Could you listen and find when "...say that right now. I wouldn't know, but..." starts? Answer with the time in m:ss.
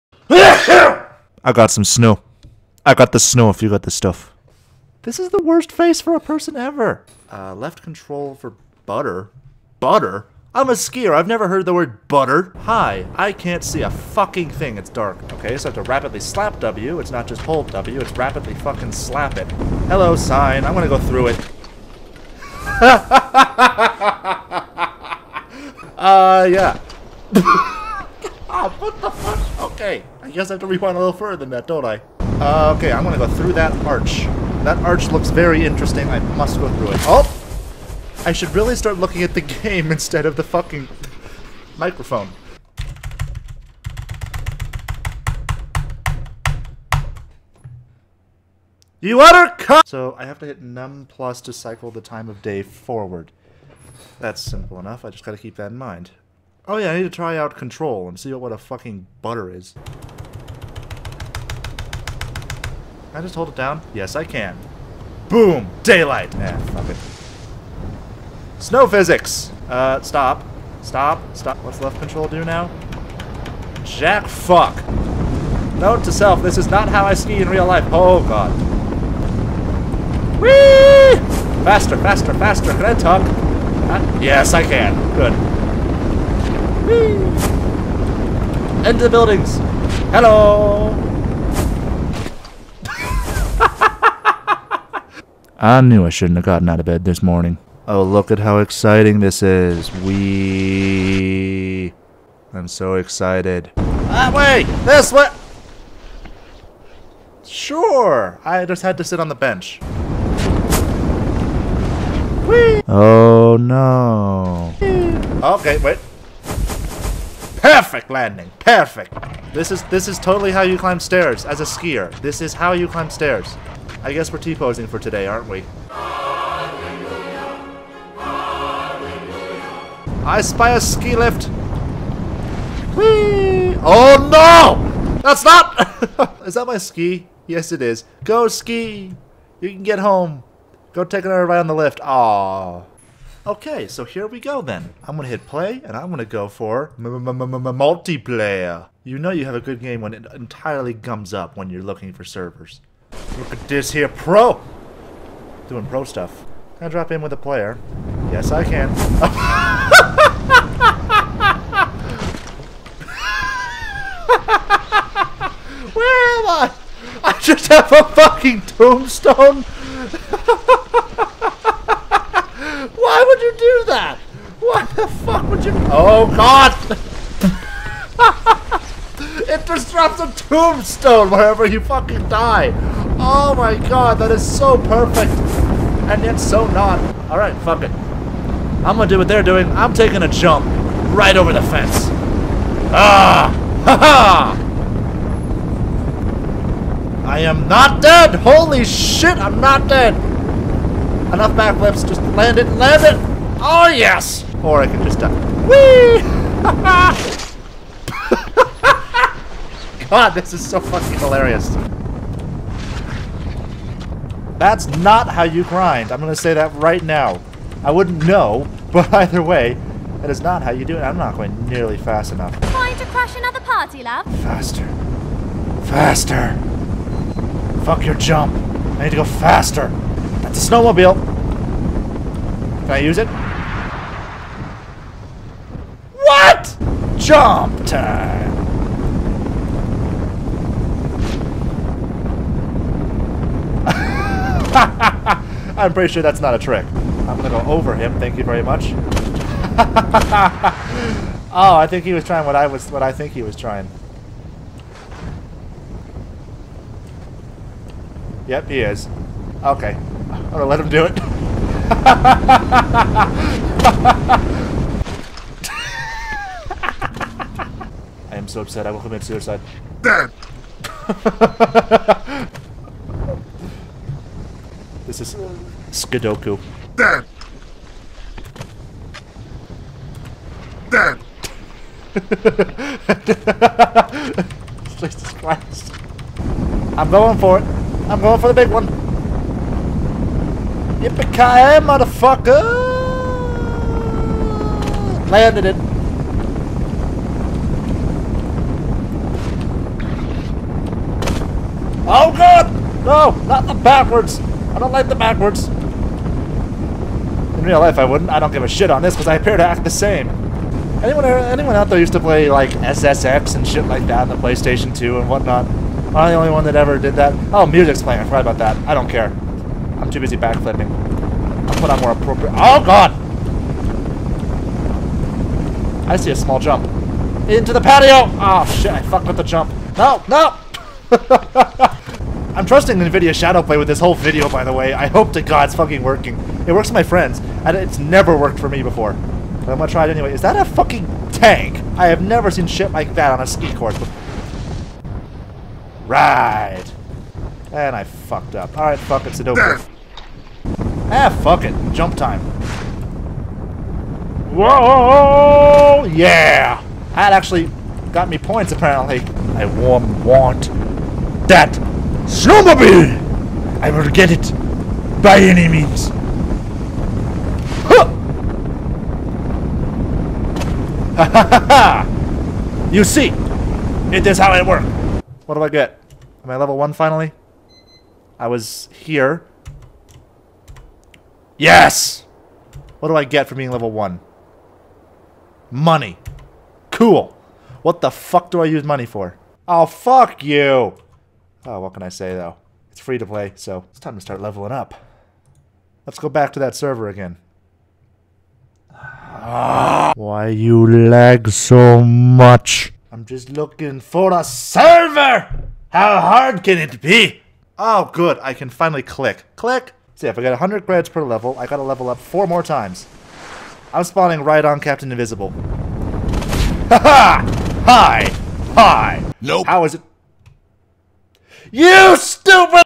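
3:36.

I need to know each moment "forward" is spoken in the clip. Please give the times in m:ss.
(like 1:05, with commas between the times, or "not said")
0:52.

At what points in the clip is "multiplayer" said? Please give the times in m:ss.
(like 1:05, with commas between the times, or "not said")
2:26.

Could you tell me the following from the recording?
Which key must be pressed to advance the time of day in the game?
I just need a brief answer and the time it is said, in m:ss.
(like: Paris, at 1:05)
Num plus, at 0:50.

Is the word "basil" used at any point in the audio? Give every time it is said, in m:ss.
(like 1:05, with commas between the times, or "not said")
not said.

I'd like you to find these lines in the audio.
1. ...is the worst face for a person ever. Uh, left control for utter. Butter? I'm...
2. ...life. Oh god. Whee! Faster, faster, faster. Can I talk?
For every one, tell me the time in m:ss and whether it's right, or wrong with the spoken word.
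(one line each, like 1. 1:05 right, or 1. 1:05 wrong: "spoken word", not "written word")
1. 0:05 wrong: "butter", not "utter"
2. 1:17 right.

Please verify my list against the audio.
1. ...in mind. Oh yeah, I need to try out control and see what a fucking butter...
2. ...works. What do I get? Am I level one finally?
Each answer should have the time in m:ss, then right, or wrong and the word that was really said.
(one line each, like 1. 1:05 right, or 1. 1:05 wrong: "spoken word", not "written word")
1. 0:55 right
2. 6:14 right.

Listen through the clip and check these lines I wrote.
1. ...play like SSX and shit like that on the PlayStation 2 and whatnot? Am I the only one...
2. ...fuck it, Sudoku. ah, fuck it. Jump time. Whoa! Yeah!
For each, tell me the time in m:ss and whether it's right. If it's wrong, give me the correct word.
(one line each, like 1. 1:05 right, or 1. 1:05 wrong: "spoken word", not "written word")
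1. 5:12 right
2. 5:48 right.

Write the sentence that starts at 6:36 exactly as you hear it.
Let's go back to that server again.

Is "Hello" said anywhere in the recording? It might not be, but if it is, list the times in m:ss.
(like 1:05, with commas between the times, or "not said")
0:19, 1:30.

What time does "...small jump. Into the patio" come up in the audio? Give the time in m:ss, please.
5:26.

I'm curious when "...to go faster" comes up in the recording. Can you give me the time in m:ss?
3:49.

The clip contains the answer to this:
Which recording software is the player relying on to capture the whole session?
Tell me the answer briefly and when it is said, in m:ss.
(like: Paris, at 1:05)
NVIDIA Shadowplay, at 5:32.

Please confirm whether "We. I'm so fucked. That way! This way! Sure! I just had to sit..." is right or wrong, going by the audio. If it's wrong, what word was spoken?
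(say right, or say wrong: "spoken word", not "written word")
wrong: "excited", not "fucked".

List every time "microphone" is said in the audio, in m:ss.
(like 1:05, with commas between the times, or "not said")
0:41.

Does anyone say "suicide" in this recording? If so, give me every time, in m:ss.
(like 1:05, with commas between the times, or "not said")
4:29.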